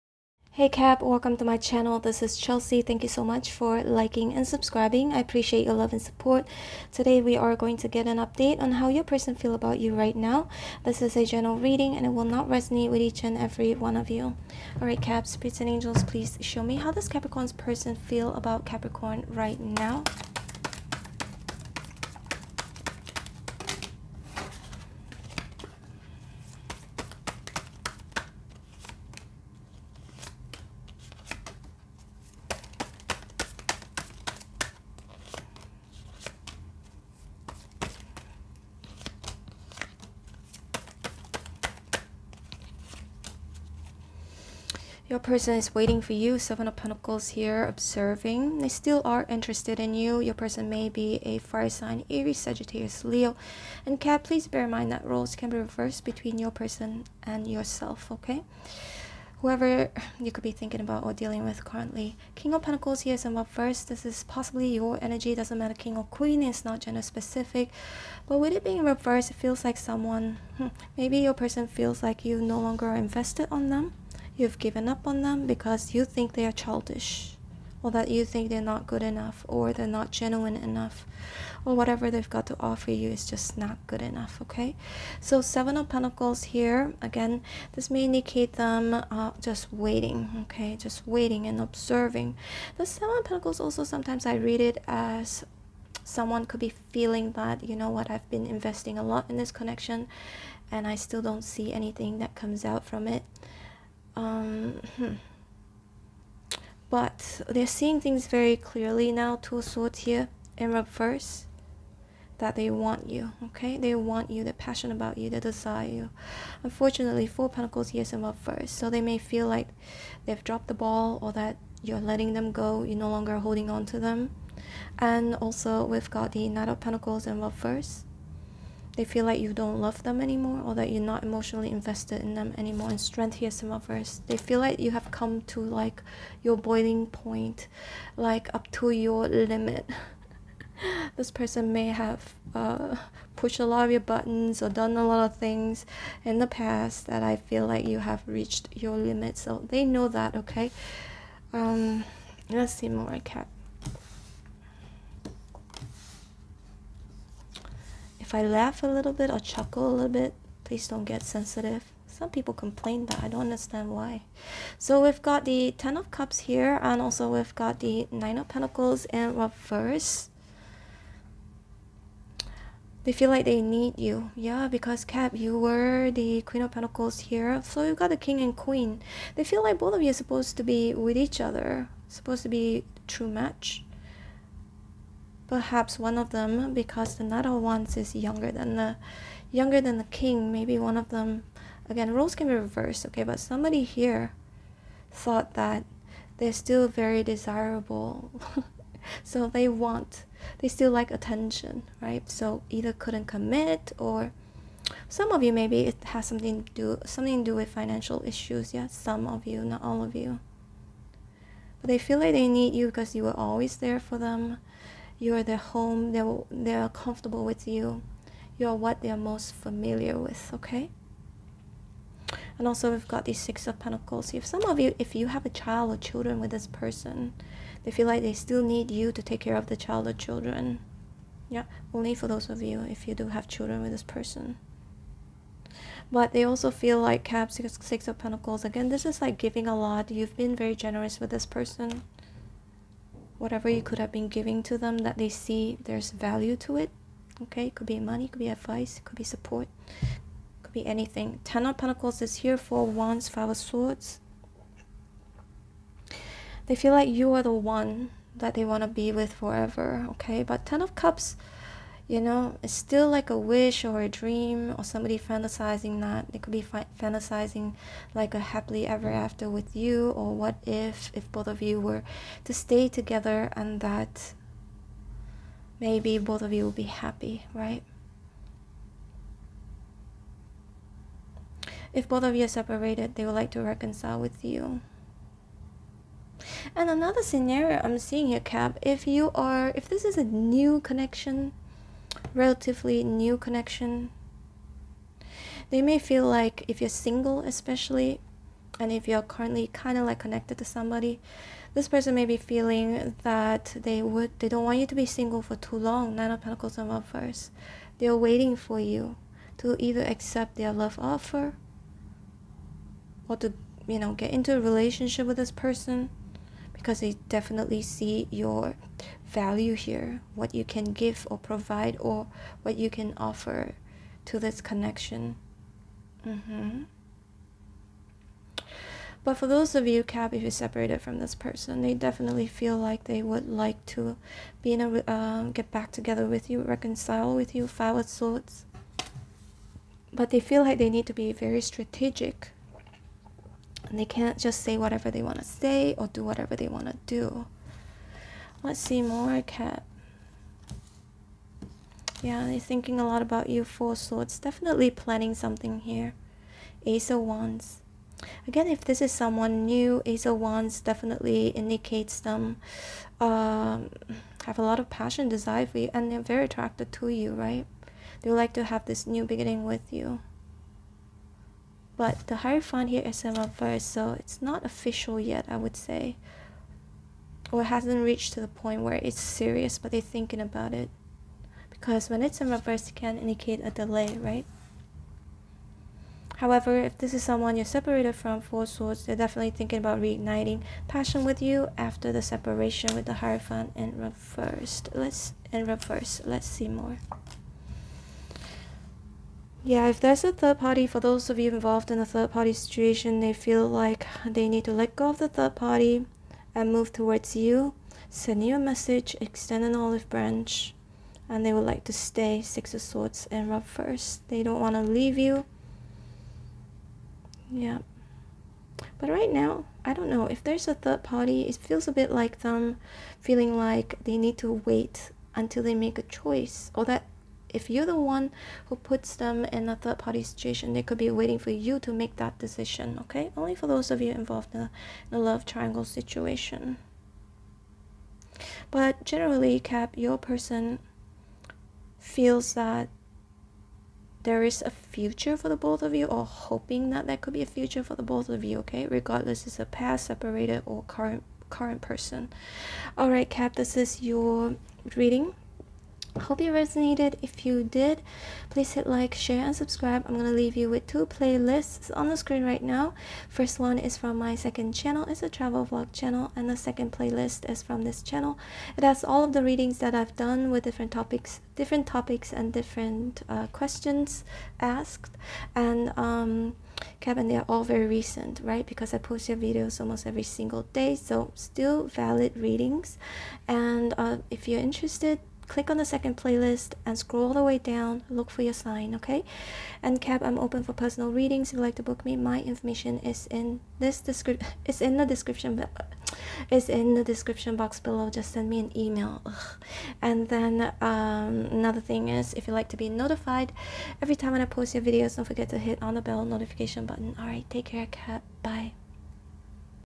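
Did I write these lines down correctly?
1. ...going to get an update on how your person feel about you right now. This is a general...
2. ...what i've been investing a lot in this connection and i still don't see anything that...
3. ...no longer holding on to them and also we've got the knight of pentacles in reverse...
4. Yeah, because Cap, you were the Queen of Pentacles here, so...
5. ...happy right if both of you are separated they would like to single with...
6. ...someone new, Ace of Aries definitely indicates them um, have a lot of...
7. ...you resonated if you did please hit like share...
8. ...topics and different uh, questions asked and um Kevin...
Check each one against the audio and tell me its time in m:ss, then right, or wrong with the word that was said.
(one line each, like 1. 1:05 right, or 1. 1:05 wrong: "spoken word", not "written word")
1. 0:07 right
2. 1:37 right
3. 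2:02 right
4. 2:54 right
5. 4:36 wrong: "reconcile", not "single"
6. 5:59 wrong: "Wands", not "Aries"
7. 7:36 right
8. 7:51 right.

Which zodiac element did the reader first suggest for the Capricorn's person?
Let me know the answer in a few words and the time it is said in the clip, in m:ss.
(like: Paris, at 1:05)
Fire sign, at 0:51.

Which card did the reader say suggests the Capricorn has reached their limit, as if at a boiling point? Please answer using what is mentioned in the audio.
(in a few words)
Strength.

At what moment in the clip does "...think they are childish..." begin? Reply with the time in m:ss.
1:16.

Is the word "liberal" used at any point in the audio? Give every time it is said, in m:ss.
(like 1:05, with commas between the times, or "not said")
not said.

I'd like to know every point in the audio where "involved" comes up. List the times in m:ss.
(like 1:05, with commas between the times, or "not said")
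6:41, 7:14.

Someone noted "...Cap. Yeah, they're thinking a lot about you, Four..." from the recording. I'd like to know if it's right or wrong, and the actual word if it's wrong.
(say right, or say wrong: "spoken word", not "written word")
right.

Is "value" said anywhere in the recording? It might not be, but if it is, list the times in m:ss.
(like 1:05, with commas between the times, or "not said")
4:06, 5:19.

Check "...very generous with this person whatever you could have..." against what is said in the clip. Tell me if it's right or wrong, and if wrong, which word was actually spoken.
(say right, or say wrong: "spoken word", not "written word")
right.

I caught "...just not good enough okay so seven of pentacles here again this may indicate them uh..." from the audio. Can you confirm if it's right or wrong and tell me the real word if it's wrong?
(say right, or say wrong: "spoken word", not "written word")
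right.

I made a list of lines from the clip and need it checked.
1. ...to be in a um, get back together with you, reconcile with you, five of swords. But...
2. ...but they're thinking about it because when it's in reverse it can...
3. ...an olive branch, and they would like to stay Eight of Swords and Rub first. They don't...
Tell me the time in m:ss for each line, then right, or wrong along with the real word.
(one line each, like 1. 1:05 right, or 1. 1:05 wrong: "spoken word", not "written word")
1. 5:33 right
2. 6:19 right
3. 6:49 wrong: "Six", not "Eight".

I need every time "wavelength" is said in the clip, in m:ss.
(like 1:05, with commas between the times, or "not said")
not said.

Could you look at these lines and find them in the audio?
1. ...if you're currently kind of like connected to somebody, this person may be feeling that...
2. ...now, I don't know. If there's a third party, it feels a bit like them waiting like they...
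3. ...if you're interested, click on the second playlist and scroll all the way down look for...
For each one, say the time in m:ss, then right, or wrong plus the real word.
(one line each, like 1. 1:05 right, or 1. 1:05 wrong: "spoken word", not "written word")
1. 4:58 right
2. 6:59 wrong: "feeling", not "waiting"
3. 8:04 right.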